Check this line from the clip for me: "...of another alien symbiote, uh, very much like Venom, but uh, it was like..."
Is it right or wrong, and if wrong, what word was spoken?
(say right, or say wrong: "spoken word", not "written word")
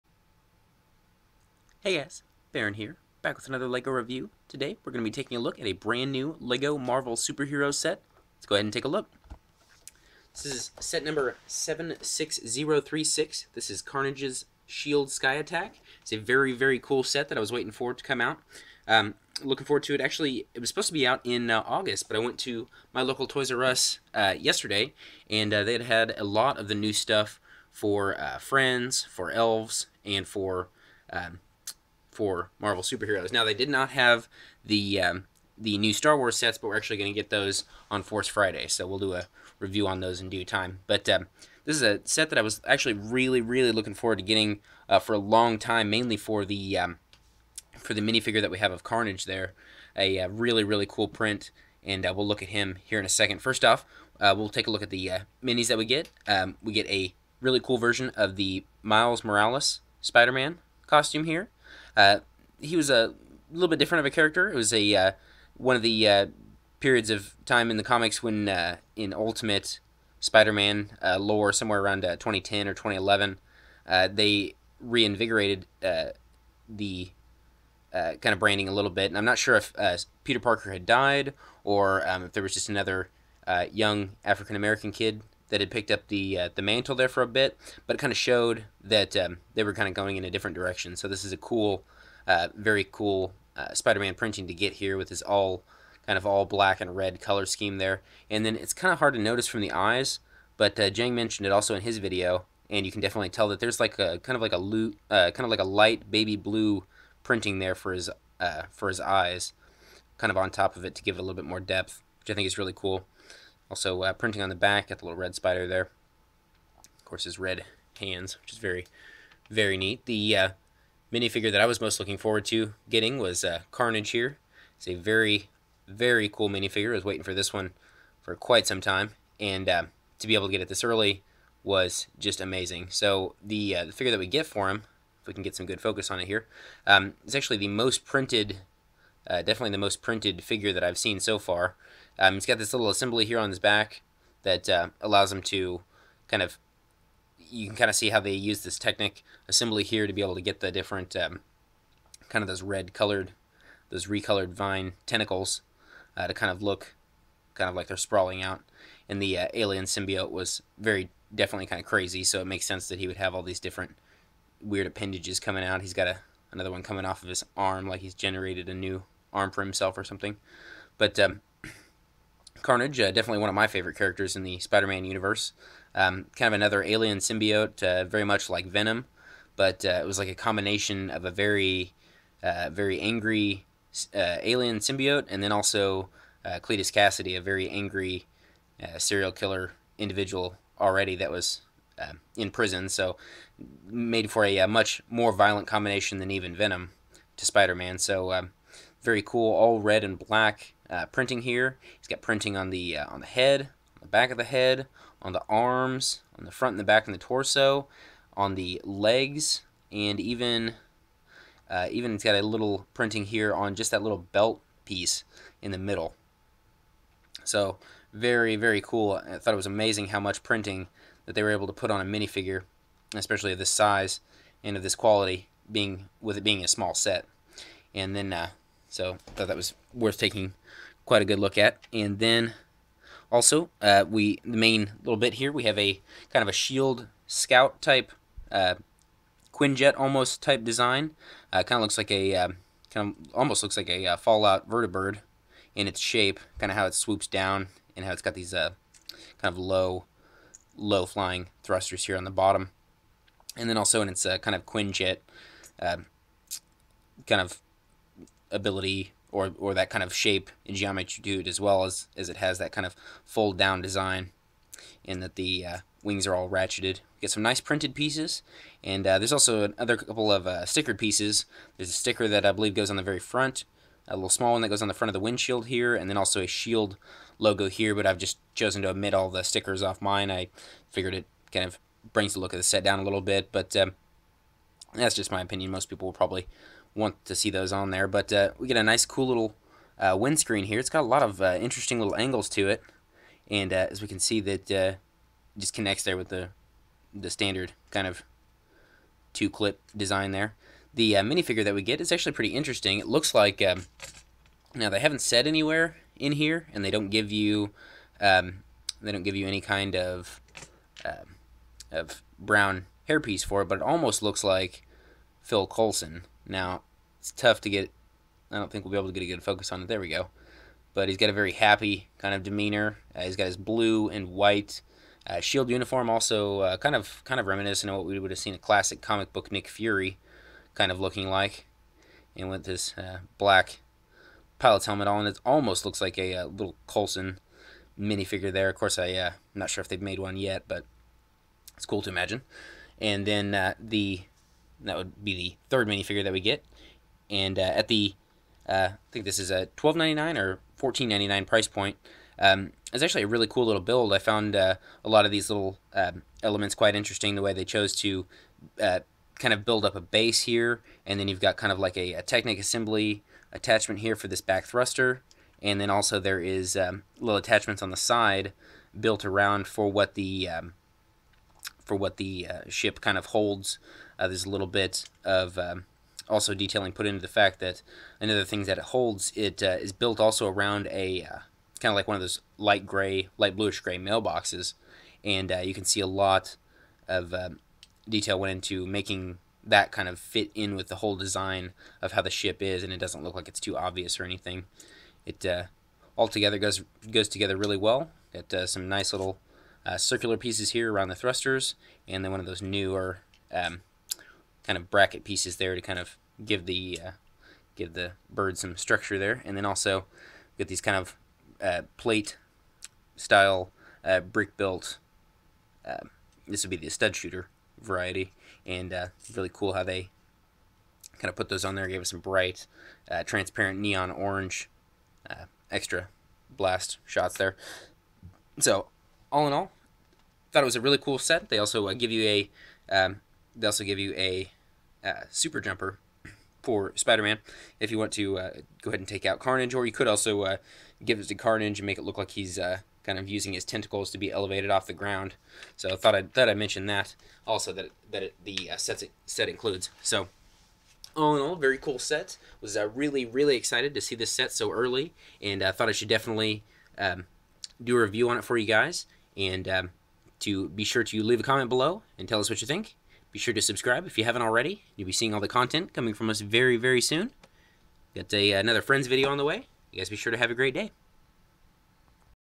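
right.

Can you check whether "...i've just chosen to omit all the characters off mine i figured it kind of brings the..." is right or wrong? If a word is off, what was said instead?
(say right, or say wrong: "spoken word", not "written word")
wrong: "stickers", not "characters".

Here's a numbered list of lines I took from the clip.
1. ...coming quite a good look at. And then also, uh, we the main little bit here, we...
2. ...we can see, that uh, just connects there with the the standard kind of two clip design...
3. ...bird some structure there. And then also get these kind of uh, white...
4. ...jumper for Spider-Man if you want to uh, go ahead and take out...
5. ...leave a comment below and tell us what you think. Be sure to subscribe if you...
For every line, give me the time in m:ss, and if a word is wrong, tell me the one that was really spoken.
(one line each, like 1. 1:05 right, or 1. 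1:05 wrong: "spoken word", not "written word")
1. 3:50 wrong: "taking", not "coming"
2. 4:54 right
3. 6:48 wrong: "plate", not "white"
4. 7:15 right
5. 7:41 right.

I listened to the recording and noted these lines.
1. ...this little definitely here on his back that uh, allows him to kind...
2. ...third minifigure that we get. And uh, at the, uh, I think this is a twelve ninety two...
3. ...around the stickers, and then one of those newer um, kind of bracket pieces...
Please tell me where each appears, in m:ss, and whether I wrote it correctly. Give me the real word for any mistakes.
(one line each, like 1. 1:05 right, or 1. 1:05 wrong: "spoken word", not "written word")
1. 2:22 wrong: "assembly", not "definitely"
2. 5:45 wrong: "nine", not "two"
3. 6:40 wrong: "thrusters", not "stickers".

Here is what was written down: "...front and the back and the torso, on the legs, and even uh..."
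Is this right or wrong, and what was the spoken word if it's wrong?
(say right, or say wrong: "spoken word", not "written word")
right.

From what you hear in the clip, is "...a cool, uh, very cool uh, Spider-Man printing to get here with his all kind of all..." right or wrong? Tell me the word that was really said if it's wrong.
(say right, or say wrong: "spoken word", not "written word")
right.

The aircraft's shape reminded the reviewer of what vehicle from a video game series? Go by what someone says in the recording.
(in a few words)
Fallout vertibird.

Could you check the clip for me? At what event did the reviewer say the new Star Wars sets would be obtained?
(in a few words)
Force Friday.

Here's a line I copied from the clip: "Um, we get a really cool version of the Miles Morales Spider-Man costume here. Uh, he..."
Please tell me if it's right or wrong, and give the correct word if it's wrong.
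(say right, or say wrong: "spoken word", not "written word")
right.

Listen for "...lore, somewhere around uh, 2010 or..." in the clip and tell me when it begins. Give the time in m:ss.
1:11.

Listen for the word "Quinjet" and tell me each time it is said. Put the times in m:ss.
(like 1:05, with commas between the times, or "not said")
3:59, 4:14.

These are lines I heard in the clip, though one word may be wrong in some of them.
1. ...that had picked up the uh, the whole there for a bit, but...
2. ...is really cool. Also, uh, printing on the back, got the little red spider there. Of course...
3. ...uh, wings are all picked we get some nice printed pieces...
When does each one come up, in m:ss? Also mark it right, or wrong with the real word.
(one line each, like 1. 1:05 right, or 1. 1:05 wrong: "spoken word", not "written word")
1. 1:25 wrong: "mantle", not "whole"
2. 1:52 right
3. 4:25 wrong: "ratcheted", not "picked".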